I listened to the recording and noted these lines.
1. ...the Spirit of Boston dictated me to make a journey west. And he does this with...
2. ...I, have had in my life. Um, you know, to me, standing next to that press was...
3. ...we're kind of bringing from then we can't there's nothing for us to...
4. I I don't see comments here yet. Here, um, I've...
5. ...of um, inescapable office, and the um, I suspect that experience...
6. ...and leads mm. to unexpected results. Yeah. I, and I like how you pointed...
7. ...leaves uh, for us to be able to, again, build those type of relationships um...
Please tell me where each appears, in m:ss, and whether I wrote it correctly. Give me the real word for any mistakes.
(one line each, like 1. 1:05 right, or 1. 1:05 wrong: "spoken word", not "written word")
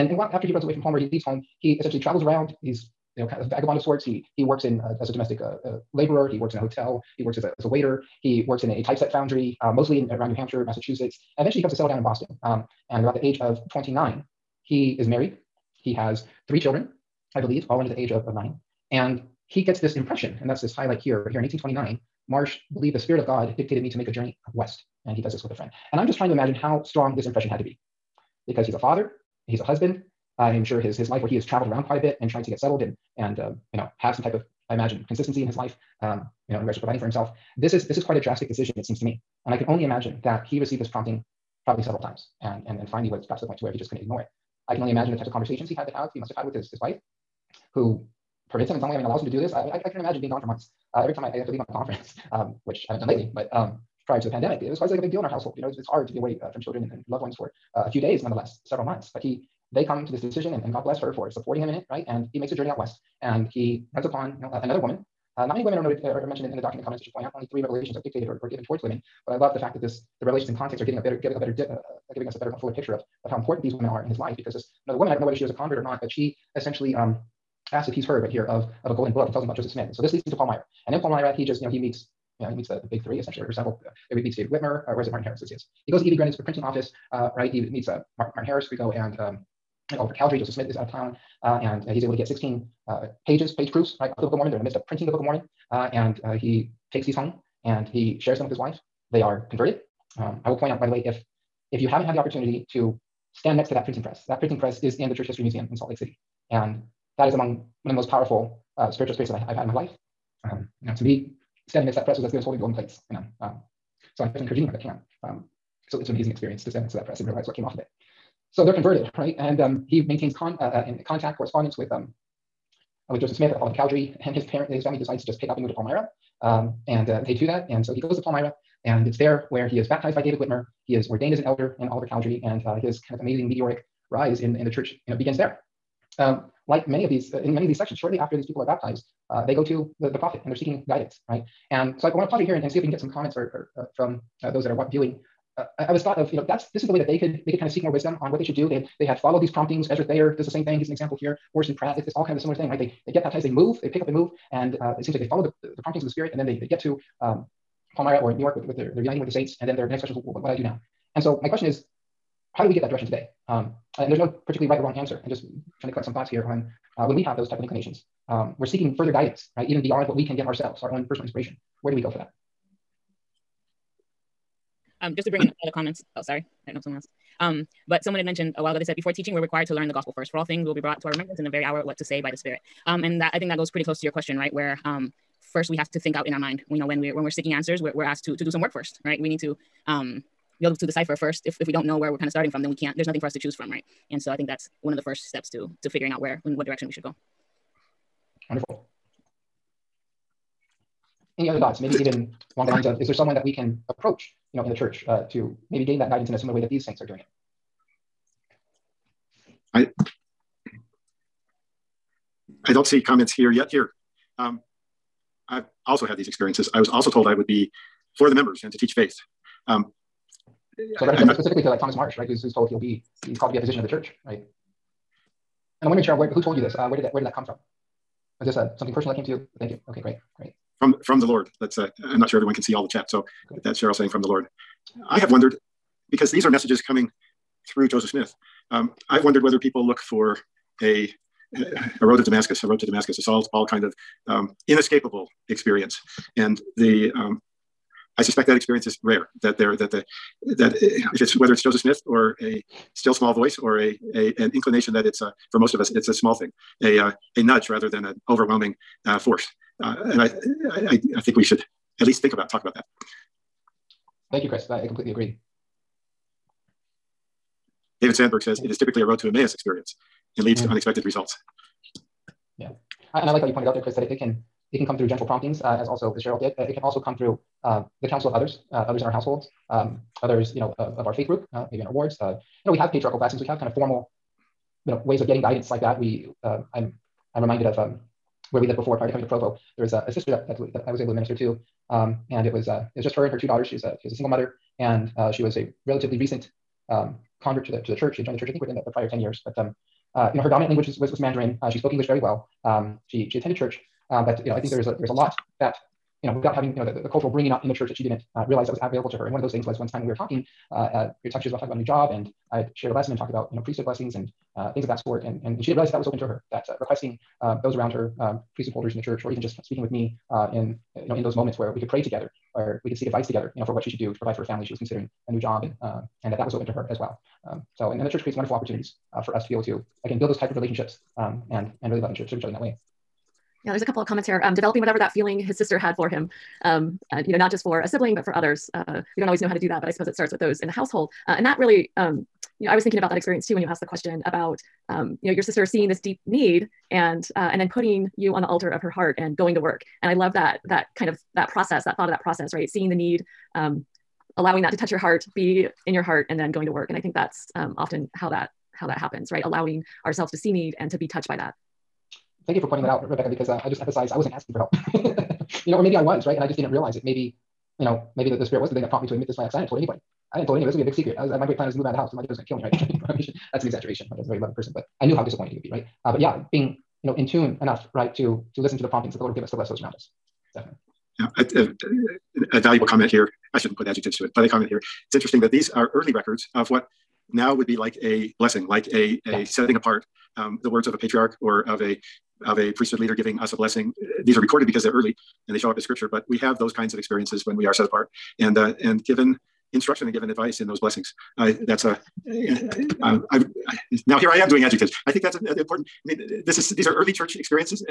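1. 0:22 wrong: "God", not "Boston"
2. 1:49 right
3. 3:12 wrong: "starting", not "bringing"
4. 3:29 right
5. 4:03 wrong: "experience", not "office"
6. 4:30 right
7. 5:28 wrong: "opportunities", not "leaves".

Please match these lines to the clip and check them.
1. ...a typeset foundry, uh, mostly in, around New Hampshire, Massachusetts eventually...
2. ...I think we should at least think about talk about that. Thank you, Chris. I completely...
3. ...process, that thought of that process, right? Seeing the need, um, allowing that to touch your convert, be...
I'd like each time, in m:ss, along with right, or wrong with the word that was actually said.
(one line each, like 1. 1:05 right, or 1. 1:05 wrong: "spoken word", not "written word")
1. 0:08 right
2. 4:21 right
3. 5:51 wrong: "heart", not "convert".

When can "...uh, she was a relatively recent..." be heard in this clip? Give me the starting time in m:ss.
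4:55.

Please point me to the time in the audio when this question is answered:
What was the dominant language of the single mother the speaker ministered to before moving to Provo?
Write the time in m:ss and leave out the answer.
5:01.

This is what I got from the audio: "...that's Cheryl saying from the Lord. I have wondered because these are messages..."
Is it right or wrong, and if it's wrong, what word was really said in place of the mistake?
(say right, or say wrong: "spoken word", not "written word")
right.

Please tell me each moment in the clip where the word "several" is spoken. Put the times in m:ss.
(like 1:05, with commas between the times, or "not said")
0:41, 0:58, 1:23.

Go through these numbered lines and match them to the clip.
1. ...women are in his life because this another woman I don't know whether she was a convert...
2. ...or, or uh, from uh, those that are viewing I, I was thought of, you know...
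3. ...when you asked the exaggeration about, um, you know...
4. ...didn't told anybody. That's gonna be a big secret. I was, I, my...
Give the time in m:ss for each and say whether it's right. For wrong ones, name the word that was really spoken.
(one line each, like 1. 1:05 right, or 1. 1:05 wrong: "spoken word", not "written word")
1. 1:13 right
2. 2:23 right
3. 5:43 wrong: "question", not "exaggeration"
4. 6:10 right.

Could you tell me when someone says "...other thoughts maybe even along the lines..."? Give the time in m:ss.
3:21.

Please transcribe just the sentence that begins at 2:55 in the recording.
Um, just to bring in other comments.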